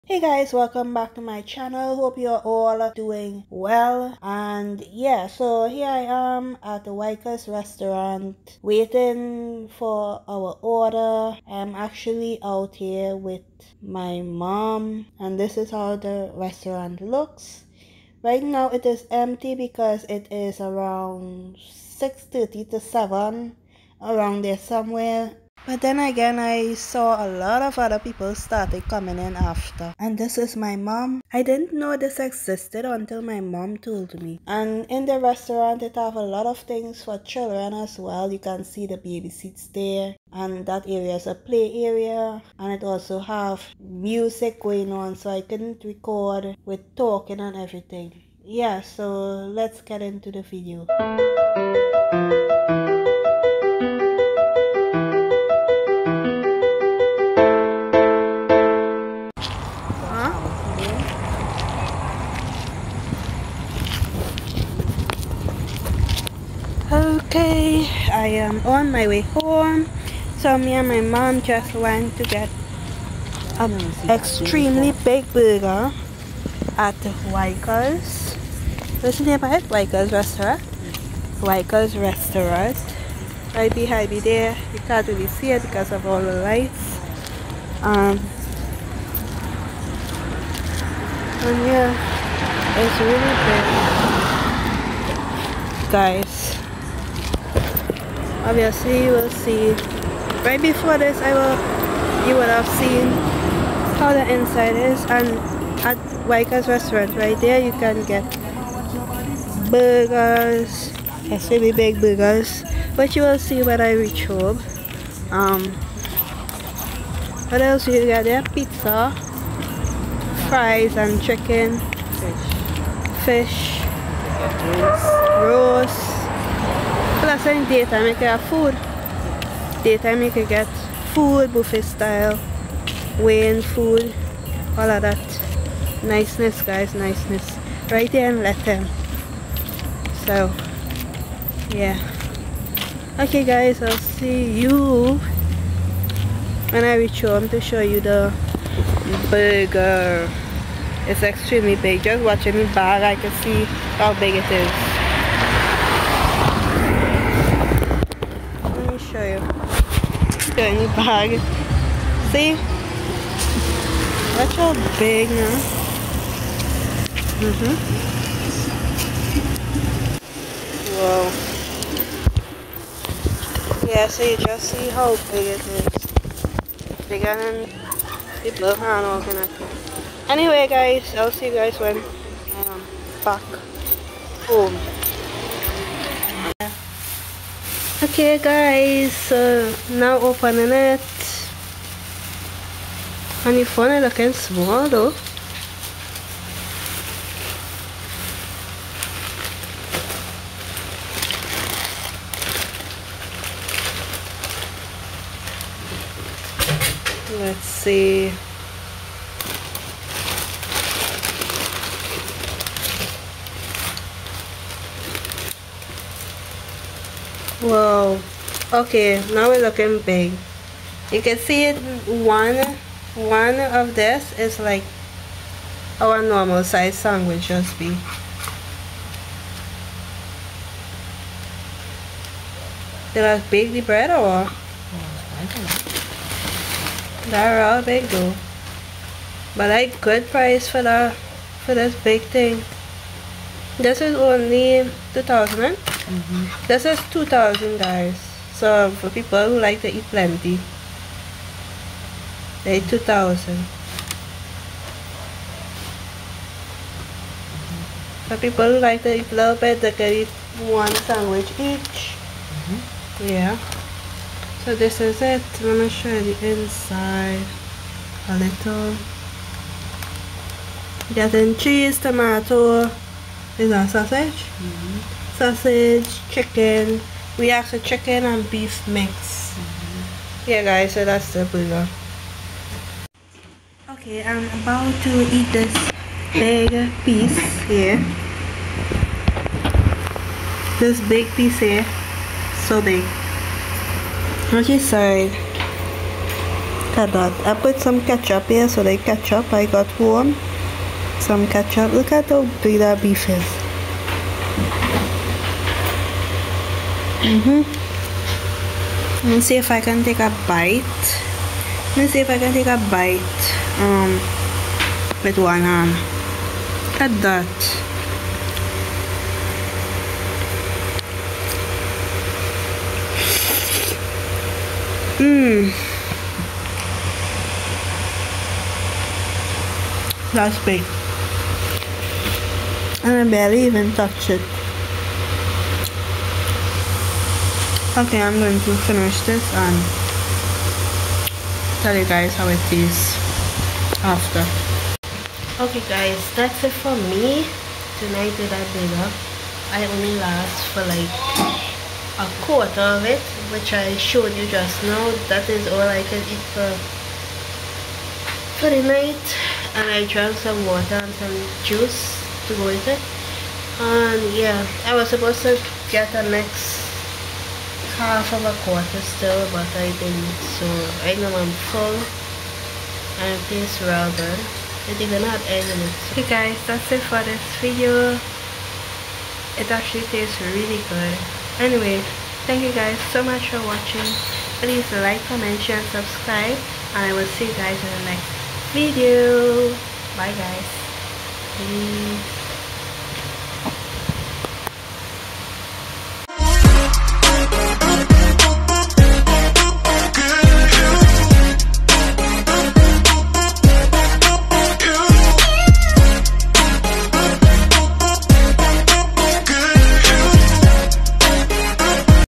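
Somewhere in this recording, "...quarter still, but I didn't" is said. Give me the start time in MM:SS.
06:08.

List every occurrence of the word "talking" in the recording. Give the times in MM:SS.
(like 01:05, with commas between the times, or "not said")
00:46.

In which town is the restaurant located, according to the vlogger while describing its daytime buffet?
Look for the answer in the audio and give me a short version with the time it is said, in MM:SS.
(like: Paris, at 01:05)
Lethem, at 02:18.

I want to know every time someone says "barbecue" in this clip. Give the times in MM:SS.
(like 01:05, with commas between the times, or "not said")
not said.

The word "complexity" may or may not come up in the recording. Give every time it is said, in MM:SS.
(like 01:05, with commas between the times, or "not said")
not said.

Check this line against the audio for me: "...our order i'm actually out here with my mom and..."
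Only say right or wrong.
right.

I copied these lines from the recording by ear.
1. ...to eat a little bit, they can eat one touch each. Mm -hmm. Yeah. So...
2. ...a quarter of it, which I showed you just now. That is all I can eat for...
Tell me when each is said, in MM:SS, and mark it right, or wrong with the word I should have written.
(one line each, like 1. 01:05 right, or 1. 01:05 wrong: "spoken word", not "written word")
1. 04:19 wrong: "sandwich", not "touch"
2. 05:52 right.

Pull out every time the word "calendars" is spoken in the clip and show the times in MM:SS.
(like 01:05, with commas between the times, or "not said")
not said.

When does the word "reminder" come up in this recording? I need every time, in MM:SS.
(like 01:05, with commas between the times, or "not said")
not said.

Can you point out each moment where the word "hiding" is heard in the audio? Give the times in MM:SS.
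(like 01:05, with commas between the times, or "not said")
not said.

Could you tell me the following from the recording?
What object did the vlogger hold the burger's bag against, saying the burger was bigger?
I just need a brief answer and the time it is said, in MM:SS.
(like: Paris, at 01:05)
blue hand organizer, at 02:58.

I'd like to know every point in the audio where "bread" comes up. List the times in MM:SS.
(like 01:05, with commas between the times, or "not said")
03:53.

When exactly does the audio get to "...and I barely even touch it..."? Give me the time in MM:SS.
05:33.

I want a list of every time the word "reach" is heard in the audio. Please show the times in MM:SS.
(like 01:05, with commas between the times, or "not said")
01:53, 02:26.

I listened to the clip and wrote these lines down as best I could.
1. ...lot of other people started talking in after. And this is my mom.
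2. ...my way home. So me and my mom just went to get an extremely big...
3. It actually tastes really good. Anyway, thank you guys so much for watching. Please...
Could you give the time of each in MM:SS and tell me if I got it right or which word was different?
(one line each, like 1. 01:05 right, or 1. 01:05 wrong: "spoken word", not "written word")
1. 00:27 wrong: "coming", not "talking"
2. 01:08 right
3. 06:19 right.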